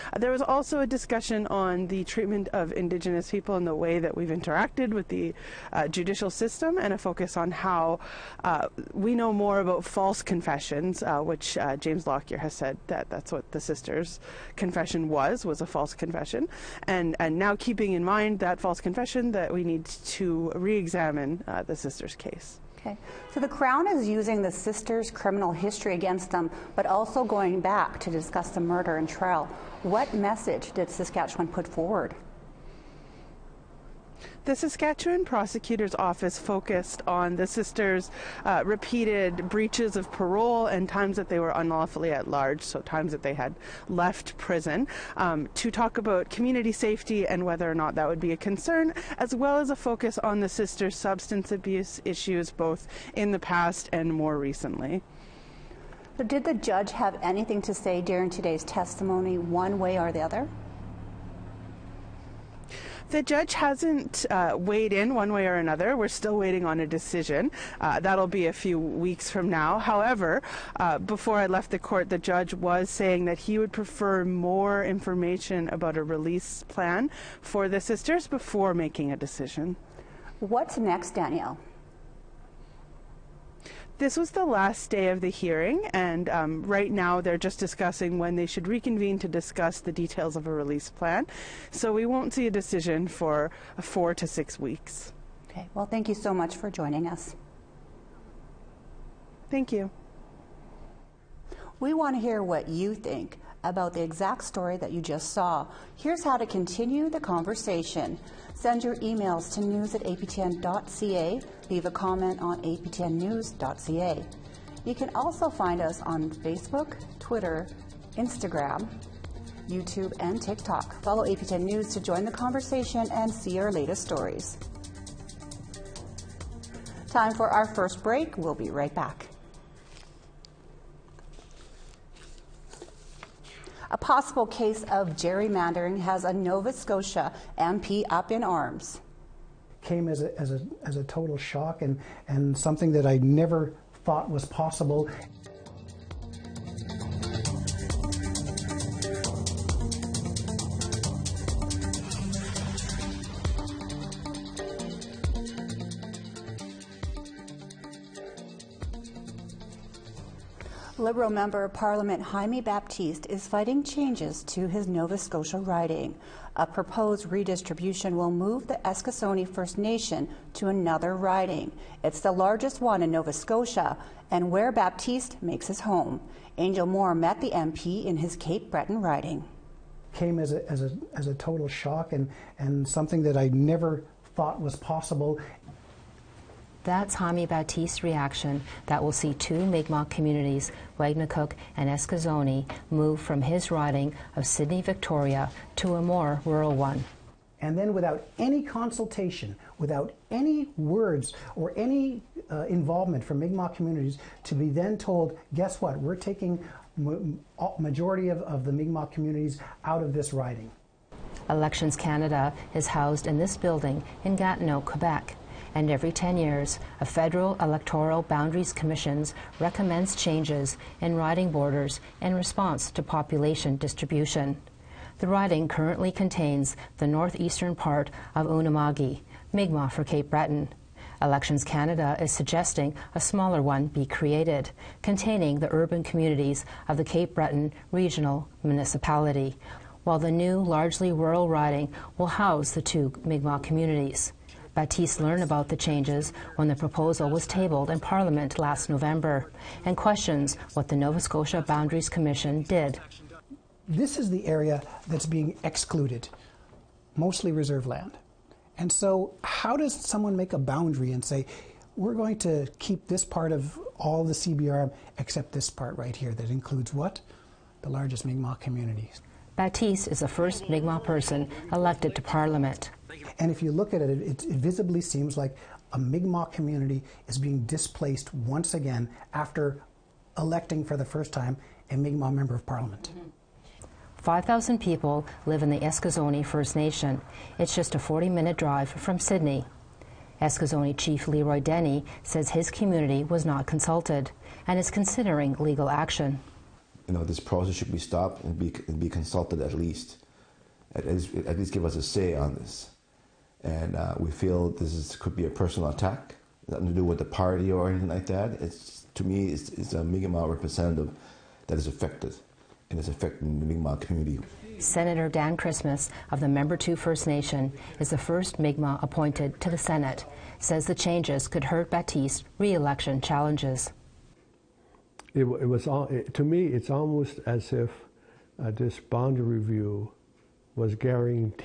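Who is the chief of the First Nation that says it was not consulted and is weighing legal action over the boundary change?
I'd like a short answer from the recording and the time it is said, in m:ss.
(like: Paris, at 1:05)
Leroy Denny, at 4:51.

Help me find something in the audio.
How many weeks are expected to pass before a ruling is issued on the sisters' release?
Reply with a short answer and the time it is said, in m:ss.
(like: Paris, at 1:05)
4 to 6 weeks, at 1:33.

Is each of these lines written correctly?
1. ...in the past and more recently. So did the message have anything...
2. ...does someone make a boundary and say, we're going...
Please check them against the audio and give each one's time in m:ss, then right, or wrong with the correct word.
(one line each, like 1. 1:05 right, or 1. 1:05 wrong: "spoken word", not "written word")
1. 0:53 wrong: "judge", not "message"
2. 4:19 right.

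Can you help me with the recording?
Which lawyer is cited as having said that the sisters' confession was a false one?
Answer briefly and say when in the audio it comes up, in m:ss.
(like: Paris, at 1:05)
James Lockyer, at 0:11.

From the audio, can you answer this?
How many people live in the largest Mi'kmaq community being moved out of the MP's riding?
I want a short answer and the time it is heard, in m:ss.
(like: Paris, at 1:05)
5,000, at 4:44.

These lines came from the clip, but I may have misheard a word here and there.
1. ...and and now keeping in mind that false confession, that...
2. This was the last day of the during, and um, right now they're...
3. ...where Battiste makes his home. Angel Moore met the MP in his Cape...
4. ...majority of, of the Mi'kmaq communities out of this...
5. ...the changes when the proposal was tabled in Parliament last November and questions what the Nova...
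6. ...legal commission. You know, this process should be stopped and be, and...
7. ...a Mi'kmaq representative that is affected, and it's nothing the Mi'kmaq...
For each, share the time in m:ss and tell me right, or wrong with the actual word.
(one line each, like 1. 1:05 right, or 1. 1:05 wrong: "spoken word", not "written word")
1. 0:16 right
2. 1:23 wrong: "hearing", not "during"
3. 2:54 right
4. 3:27 right
5. 4:05 right
6. 4:55 wrong: "action", not "commission"
7. 5:09 wrong: "affecting", not "nothing".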